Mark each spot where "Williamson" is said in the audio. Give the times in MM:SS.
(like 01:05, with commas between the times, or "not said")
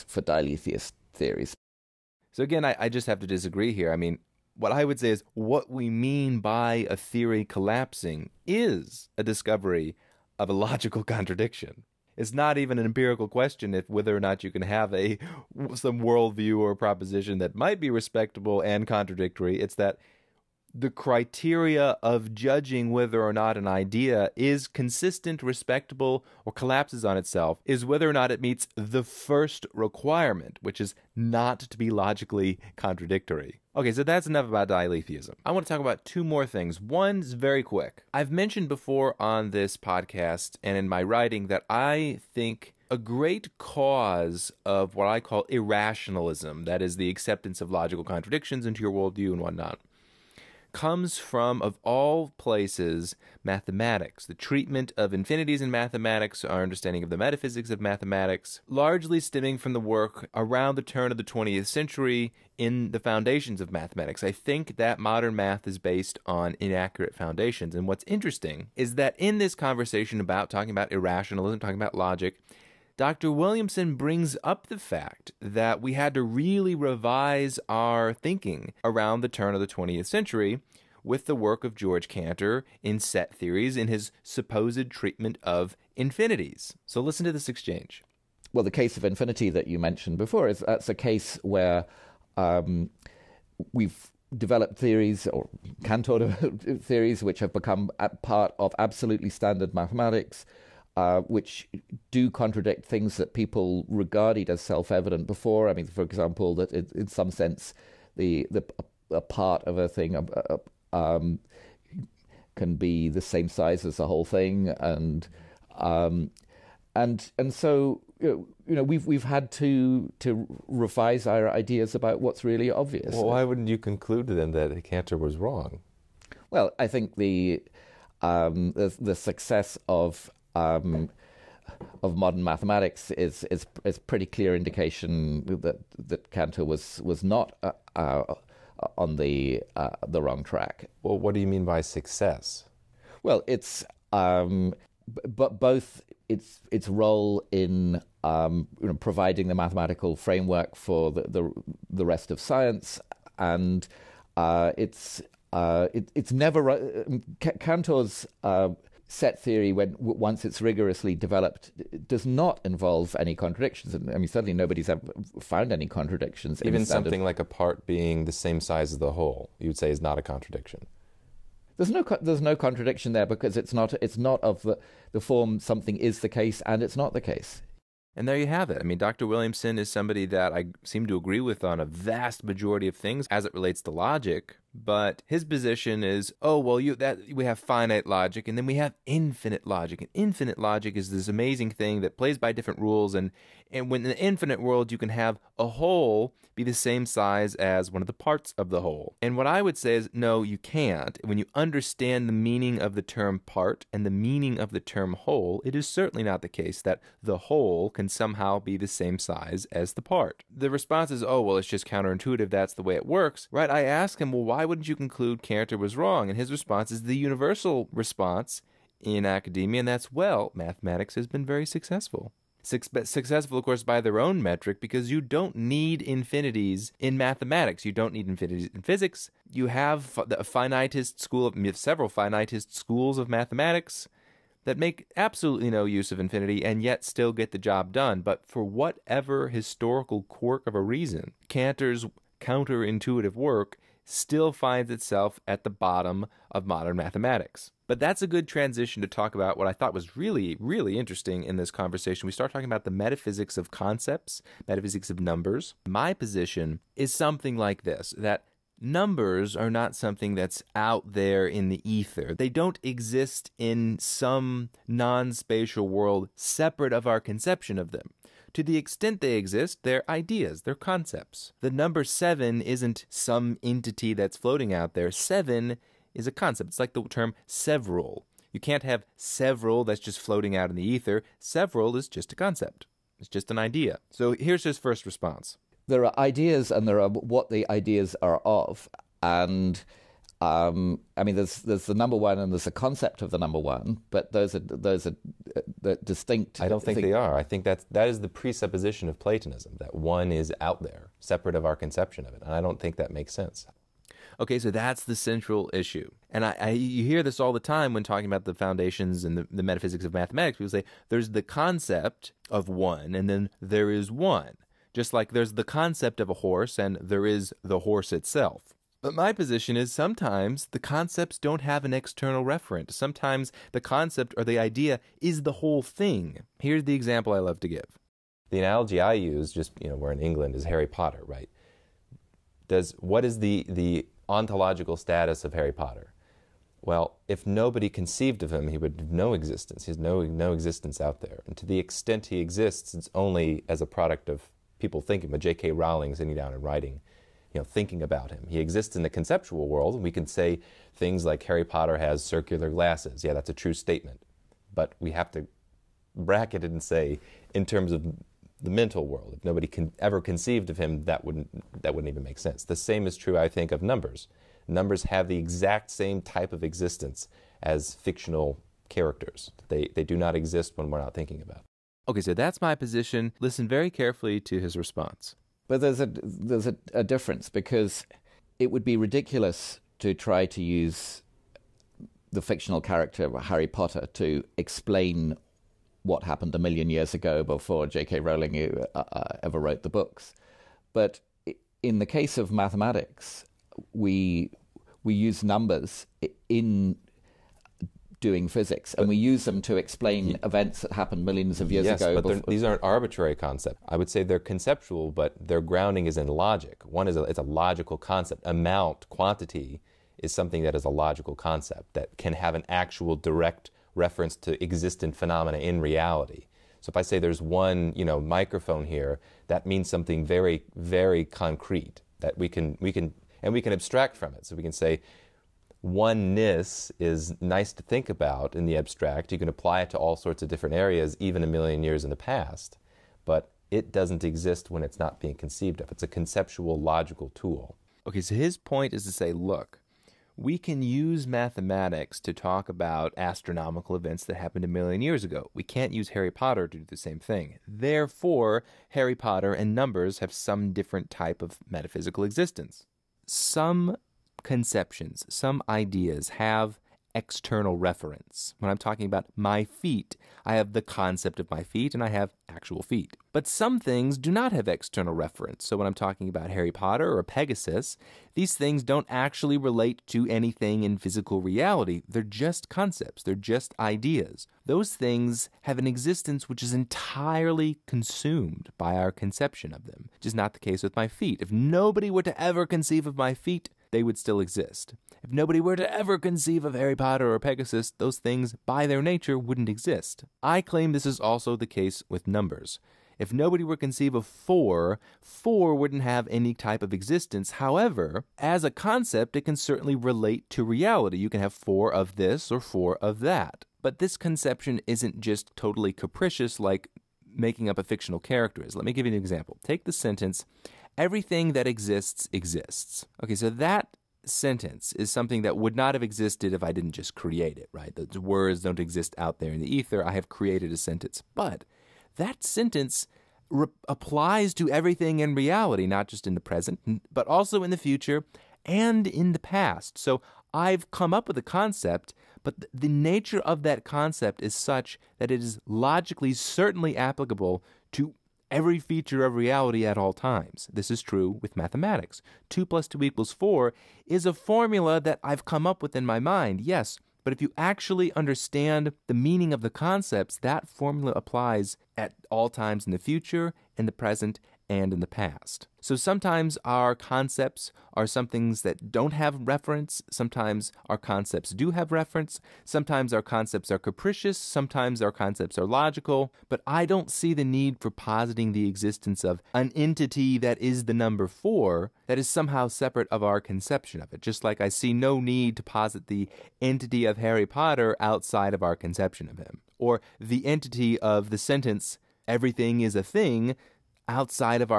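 01:13, 02:59.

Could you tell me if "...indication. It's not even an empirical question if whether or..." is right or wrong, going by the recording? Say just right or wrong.
wrong.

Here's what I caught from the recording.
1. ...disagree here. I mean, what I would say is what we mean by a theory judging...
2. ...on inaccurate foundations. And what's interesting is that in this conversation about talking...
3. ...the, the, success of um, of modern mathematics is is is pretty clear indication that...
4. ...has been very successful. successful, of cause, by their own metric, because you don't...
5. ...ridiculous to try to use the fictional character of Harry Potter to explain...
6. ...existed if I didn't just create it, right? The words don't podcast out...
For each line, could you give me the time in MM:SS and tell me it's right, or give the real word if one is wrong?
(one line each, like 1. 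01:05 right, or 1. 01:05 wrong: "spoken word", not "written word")
1. 00:03 wrong: "collapsing", not "judging"
2. 01:06 right
3. 02:08 right
4. 03:41 wrong: "course", not "cause"
5. 06:18 right
6. 08:36 wrong: "exist", not "podcast".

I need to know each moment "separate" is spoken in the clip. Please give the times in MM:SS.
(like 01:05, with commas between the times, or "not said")
04:26, 05:01, 09:32.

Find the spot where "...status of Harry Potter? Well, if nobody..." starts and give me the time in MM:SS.
05:34.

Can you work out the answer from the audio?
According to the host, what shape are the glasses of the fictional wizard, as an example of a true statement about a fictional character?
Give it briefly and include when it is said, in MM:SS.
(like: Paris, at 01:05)
circular, at 05:52.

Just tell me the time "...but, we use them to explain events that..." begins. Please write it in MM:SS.
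06:39.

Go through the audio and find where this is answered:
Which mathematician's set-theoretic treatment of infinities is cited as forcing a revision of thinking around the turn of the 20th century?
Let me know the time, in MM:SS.
01:21.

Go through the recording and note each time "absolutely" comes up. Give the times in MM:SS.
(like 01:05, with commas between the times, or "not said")
01:38, 03:55.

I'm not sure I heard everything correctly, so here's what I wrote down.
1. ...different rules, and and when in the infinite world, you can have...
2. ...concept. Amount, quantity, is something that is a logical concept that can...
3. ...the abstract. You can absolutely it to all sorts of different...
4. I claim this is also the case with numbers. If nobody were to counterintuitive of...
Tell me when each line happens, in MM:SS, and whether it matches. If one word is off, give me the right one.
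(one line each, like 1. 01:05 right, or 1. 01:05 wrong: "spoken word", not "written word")
1. 03:12 right
2. 06:47 right
3. 07:08 wrong: "apply", not "absolutely"
4. 08:10 wrong: "conceive", not "counterintuitive".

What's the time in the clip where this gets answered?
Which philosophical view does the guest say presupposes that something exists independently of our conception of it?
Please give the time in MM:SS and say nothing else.
04:59.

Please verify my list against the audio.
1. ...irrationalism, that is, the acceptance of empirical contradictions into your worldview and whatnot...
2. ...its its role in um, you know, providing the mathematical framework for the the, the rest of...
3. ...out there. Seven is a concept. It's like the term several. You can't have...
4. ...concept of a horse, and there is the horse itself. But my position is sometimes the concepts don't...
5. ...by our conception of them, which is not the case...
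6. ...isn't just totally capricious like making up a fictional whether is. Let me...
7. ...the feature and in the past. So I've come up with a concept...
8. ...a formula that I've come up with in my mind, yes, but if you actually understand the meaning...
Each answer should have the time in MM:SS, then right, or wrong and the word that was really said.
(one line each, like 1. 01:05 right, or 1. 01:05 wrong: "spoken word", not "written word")
1. 00:45 wrong: "logical", not "empirical"
2. 02:26 right
3. 04:34 right
4. 05:15 right
5. 07:58 right
6. 08:24 wrong: "character", not "whether"
7. 08:47 wrong: "future", not "feature"
8. 09:04 right.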